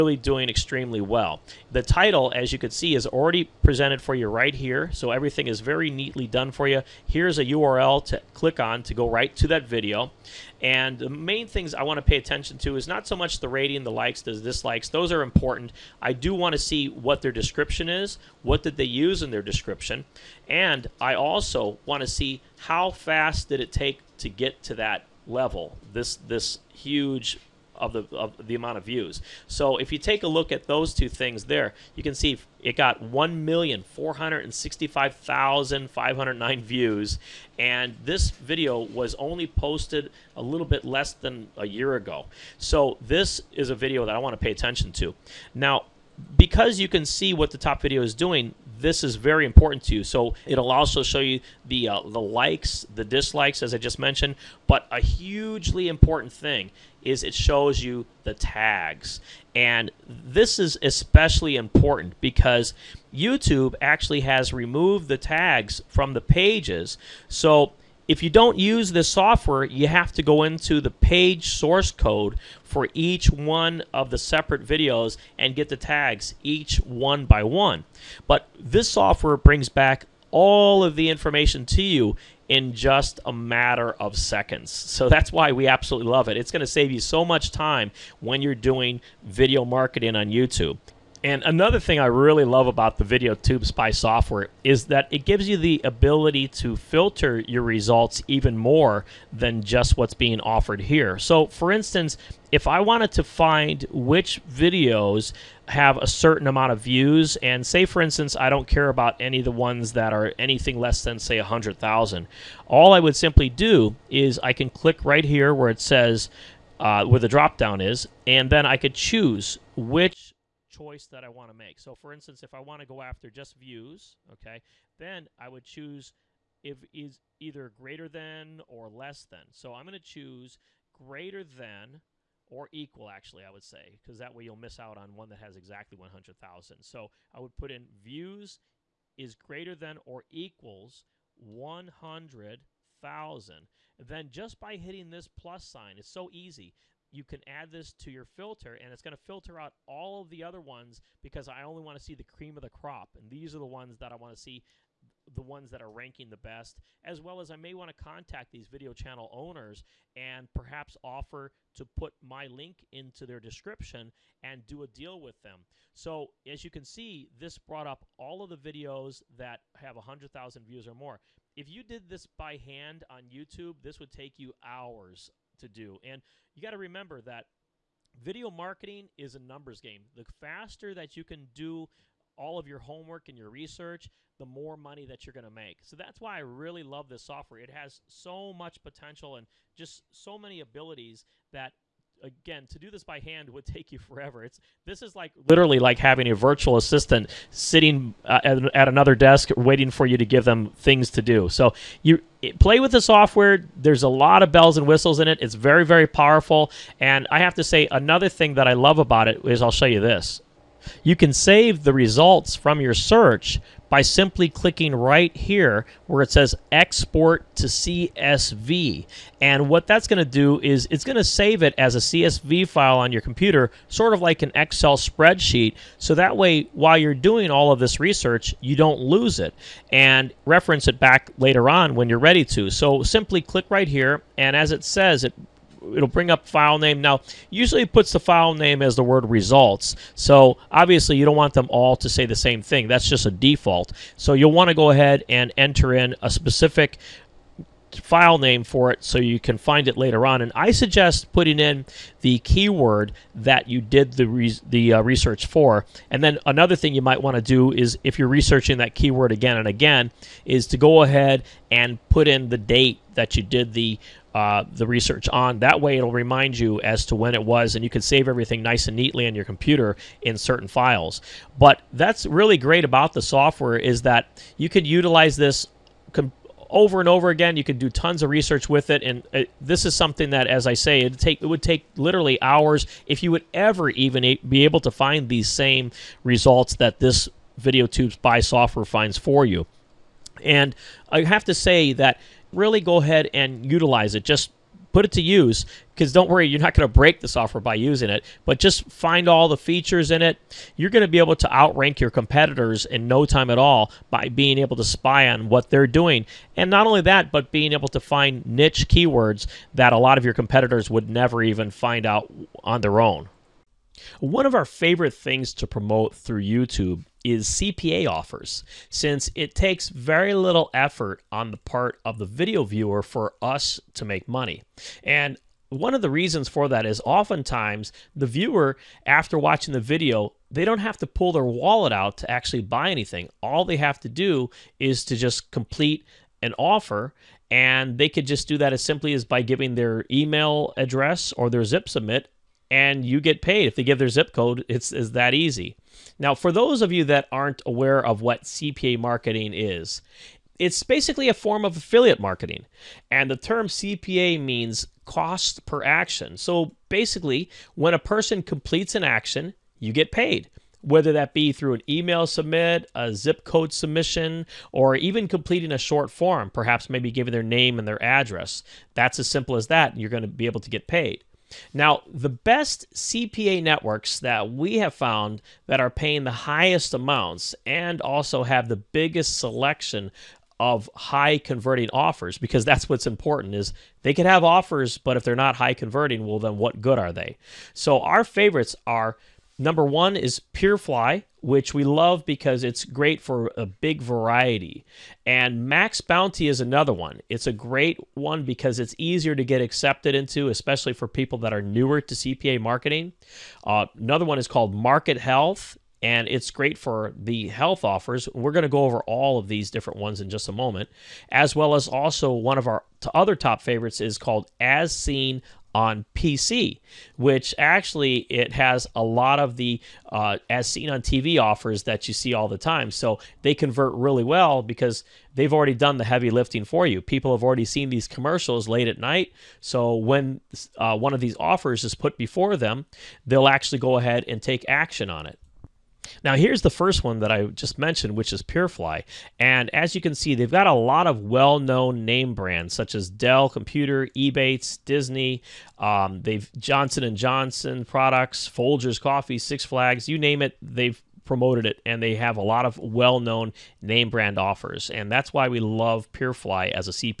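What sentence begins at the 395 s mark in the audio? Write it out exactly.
And Max Bounty is another one.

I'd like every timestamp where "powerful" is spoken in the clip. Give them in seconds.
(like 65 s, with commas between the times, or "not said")
206 s.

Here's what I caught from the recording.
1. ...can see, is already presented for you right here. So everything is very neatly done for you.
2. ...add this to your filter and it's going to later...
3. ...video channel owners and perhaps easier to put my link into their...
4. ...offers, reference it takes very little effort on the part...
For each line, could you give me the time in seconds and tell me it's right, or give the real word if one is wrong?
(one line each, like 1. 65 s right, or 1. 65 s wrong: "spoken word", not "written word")
1. 2 s right
2. 147 s wrong: "filter", not "later"
3. 158 s wrong: "offer", not "easier"
4. 318 s wrong: "since", not "reference".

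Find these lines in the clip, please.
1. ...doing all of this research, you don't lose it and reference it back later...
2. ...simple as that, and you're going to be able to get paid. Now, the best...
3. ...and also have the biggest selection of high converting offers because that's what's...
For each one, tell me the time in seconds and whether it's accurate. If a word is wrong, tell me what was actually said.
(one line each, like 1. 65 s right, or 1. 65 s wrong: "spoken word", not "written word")
1. 227 s right
2. 369 s right
3. 377 s right.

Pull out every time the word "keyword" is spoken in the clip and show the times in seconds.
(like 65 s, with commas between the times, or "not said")
252 s, 258 s, 308 s.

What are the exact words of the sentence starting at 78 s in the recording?
But this software brings back all of the information to you in just a matter of seconds.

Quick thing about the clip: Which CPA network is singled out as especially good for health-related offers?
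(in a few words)
Market Health.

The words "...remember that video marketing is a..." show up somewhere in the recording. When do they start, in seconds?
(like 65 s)
176 s.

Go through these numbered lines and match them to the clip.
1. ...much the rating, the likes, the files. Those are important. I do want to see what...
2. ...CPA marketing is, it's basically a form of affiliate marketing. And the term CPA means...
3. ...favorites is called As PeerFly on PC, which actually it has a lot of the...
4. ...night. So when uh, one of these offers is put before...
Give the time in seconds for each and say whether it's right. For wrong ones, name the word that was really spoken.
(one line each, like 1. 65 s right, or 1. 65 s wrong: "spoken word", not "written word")
1. 13 s wrong: "dislikes", not "files"
2. 348 s right
3. 413 s wrong: "Seen", not "PeerFly"
4. 428 s right.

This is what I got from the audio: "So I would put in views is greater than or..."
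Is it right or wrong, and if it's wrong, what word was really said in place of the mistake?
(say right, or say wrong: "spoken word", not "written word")
right.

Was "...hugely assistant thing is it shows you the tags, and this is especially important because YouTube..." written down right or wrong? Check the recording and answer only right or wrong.
wrong.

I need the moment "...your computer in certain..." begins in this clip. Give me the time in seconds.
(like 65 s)
269 s.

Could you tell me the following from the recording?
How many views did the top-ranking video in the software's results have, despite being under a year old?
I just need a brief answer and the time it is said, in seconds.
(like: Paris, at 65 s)
1,465,509, at 33 s.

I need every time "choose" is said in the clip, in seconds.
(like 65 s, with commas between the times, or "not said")
118 s, 125 s, 129 s.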